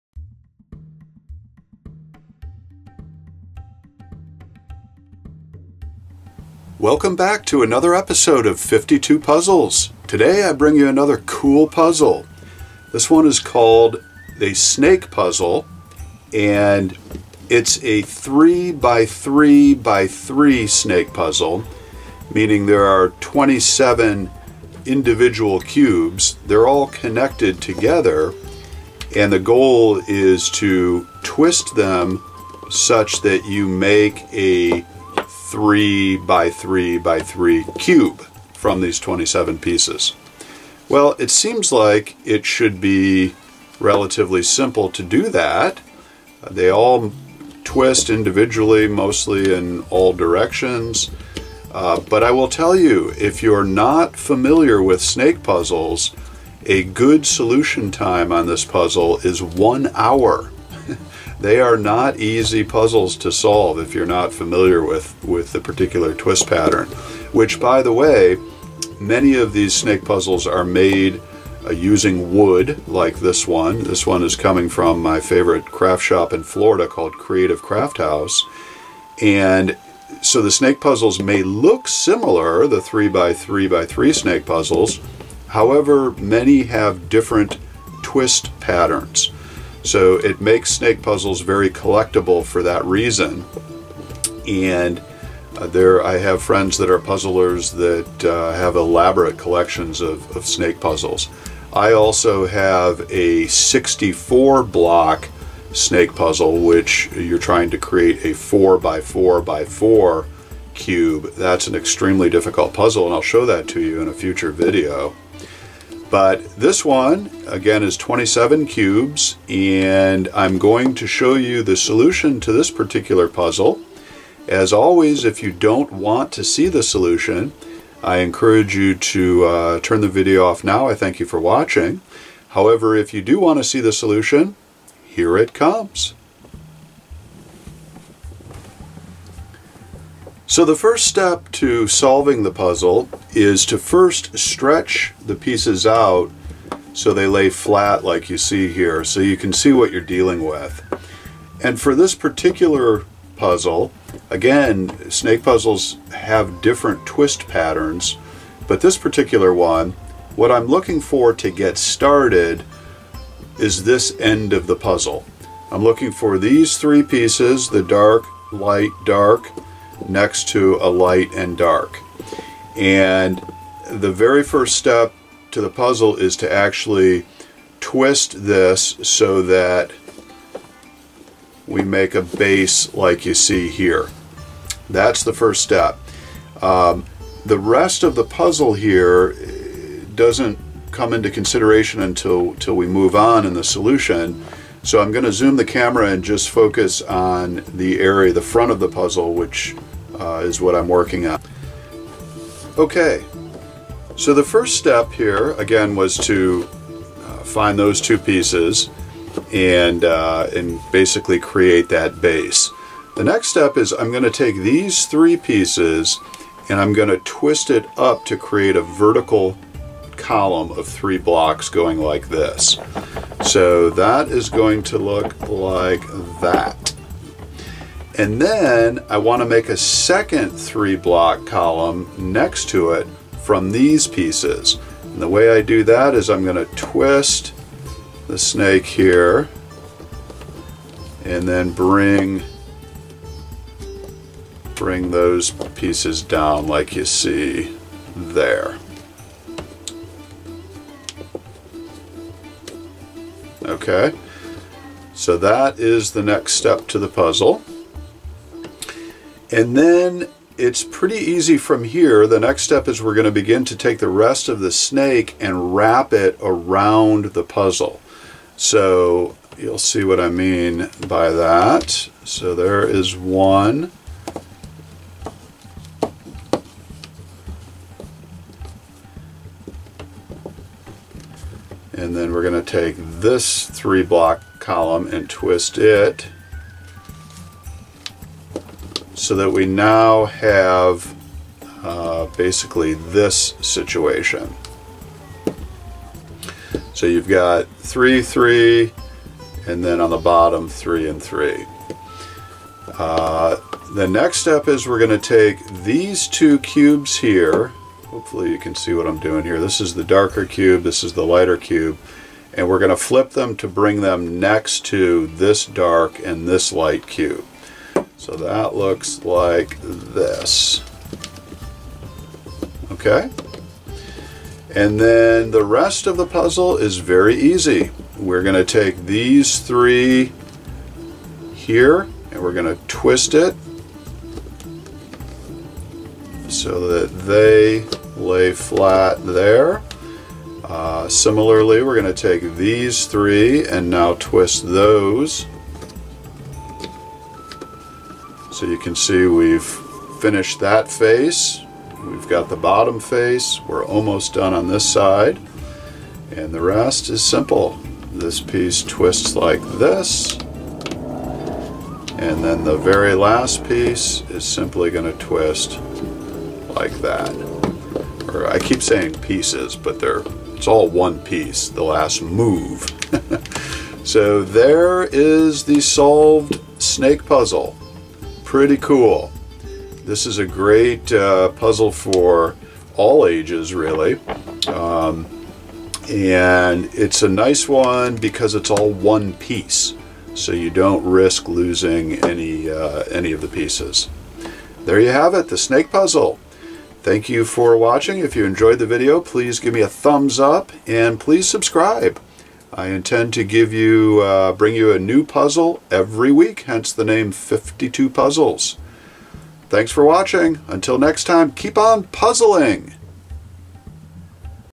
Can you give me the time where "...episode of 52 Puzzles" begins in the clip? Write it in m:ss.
0:07.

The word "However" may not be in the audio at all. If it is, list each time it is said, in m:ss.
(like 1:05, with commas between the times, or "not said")
1:25, 2:12.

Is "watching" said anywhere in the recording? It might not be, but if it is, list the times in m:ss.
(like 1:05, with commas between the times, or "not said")
2:11, 6:37, 6:50.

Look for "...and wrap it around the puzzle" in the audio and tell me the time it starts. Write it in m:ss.
4:25.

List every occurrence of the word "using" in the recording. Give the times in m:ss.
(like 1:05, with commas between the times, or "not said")
1:11.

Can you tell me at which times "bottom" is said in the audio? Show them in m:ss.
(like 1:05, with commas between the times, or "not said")
5:00, 5:52.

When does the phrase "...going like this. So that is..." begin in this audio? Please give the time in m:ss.
3:41.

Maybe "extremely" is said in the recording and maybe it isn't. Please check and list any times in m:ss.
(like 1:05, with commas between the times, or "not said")
1:51.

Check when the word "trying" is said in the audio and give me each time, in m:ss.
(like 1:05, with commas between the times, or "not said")
1:47.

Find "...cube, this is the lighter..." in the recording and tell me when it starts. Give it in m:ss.
5:10.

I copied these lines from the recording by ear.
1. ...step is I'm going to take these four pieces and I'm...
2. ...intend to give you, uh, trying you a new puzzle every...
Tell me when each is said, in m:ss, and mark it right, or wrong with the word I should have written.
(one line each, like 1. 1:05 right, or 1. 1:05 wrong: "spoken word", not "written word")
1. 3:33 wrong: "three", not "four"
2. 6:42 wrong: "bring", not "trying".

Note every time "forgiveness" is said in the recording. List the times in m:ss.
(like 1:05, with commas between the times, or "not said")
not said.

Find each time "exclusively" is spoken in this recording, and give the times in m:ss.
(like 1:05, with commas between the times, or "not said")
not said.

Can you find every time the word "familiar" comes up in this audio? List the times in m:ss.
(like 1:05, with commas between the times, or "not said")
0:54, 1:04.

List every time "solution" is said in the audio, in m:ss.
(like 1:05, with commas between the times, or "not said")
0:57, 2:01, 2:06, 2:13, 3:13.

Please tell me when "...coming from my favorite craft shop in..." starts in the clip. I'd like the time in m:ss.
1:14.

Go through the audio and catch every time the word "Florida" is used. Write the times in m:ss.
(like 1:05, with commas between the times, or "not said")
1:16.